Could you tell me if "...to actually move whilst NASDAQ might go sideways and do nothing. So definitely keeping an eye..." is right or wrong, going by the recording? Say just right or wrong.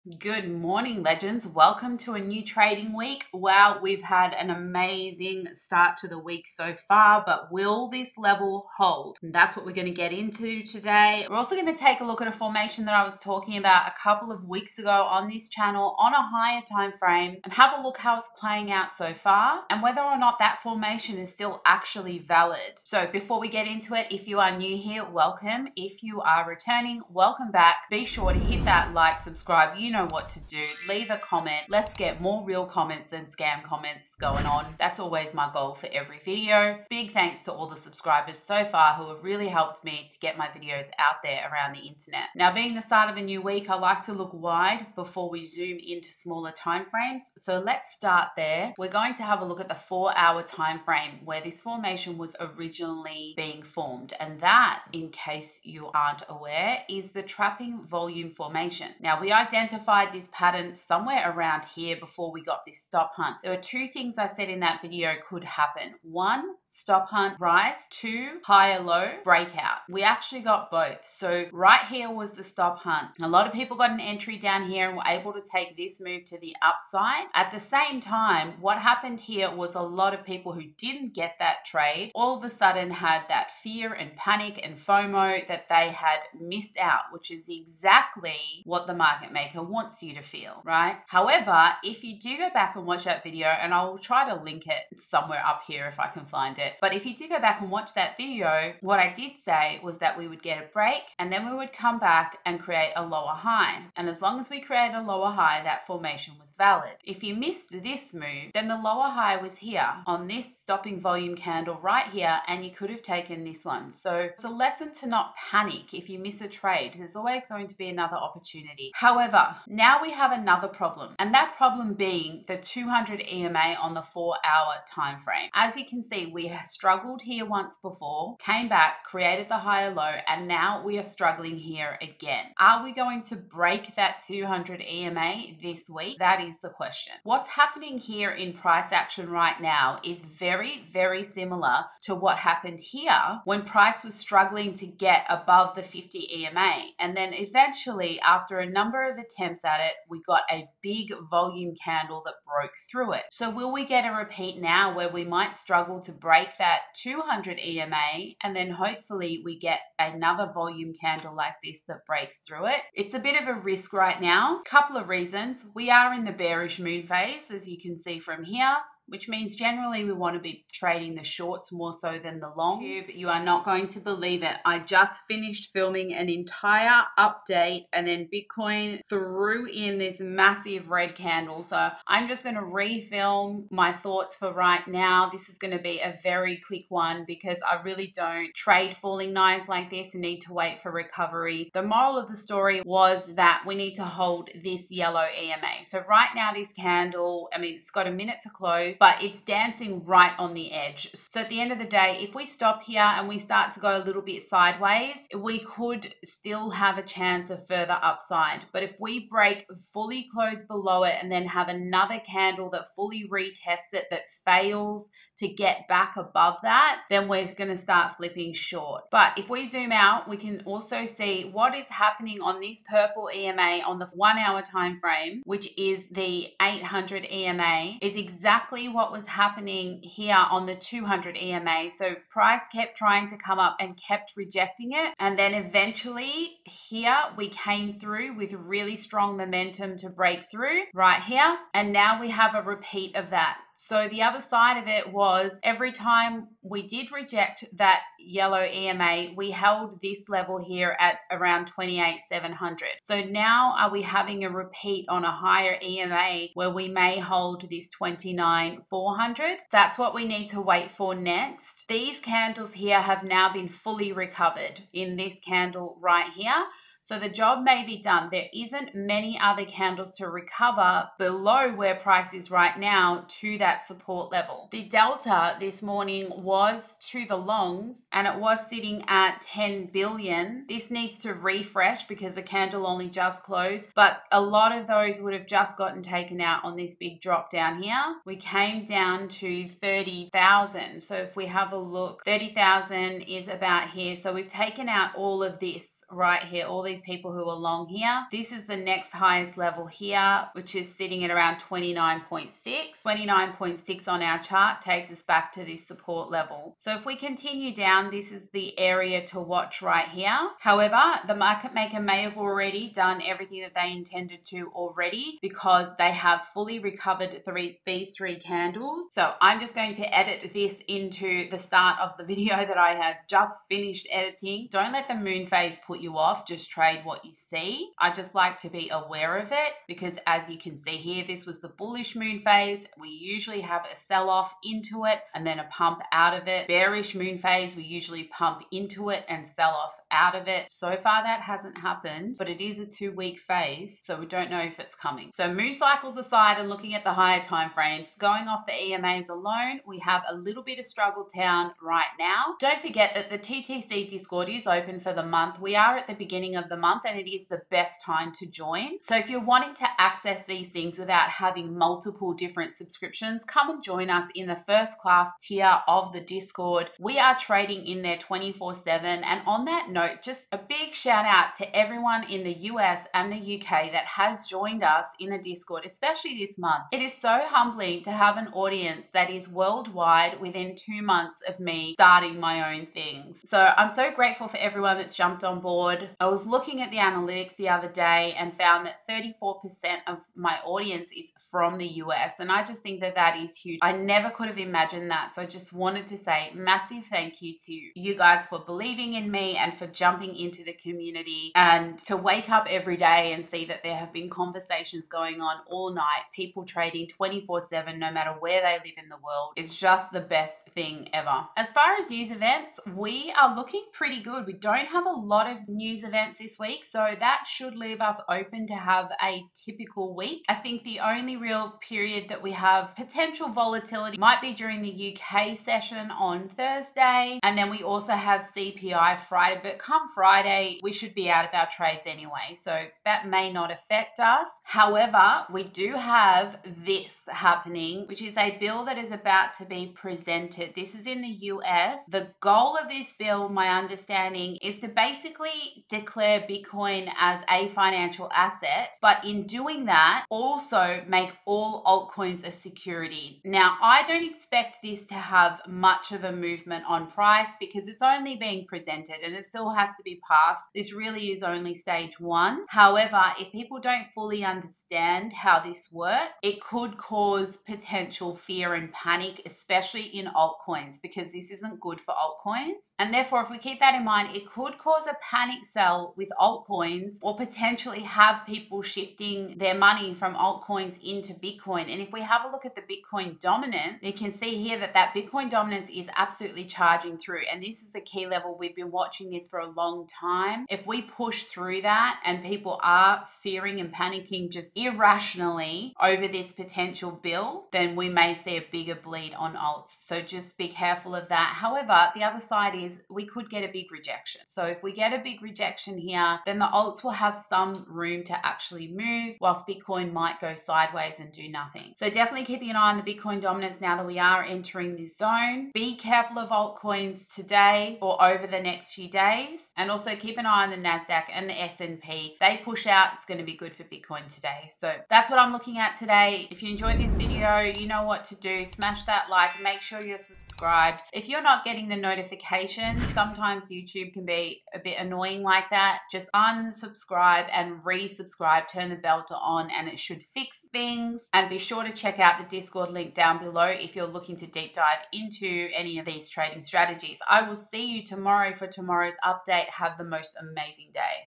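wrong.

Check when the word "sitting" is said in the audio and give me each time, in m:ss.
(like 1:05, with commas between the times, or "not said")
4:38, 5:00.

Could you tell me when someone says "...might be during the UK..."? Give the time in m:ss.
7:04.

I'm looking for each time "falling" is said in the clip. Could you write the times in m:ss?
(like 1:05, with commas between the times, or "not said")
3:08.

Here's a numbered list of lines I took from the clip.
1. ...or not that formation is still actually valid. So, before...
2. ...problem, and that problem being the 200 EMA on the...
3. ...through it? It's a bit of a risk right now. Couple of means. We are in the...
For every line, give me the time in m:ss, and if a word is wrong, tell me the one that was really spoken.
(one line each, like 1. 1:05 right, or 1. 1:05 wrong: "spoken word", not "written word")
1. 0:20 right
2. 2:00 right
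3. 2:42 wrong: "reasons", not "means".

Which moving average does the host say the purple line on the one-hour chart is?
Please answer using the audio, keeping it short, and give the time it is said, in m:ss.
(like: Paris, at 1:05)
800 EMA, at 3:46.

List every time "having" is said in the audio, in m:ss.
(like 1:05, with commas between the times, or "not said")
4:14, 6:01.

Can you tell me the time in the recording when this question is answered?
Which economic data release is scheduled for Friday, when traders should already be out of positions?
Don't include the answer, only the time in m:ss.
7:08.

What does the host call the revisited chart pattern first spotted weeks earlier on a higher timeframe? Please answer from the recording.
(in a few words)
Trapping volume formation.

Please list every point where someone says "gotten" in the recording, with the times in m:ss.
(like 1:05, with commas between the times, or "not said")
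4:45.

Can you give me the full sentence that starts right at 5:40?
So far, that hasn't happened, but it is a two week phase, so we don't know if it's coming.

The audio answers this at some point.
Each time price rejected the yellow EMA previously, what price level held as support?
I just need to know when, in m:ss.
4:11.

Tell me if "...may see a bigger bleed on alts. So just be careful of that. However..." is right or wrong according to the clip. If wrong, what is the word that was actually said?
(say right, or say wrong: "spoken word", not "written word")
right.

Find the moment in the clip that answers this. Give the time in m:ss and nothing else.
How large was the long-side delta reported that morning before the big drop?
4:39.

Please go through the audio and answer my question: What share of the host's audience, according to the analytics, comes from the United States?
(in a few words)
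34%.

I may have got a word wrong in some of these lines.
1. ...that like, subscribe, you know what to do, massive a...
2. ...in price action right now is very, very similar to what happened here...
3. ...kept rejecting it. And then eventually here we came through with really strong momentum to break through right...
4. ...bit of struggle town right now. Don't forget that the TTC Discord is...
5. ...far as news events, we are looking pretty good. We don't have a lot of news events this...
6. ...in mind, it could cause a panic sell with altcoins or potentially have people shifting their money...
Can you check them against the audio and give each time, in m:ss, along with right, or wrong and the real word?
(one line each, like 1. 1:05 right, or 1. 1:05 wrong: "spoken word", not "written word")
1. 0:28 wrong: "leave", not "massive"
2. 2:18 right
3. 3:53 right
4. 5:50 right
5. 6:51 right
6. 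7:53 right.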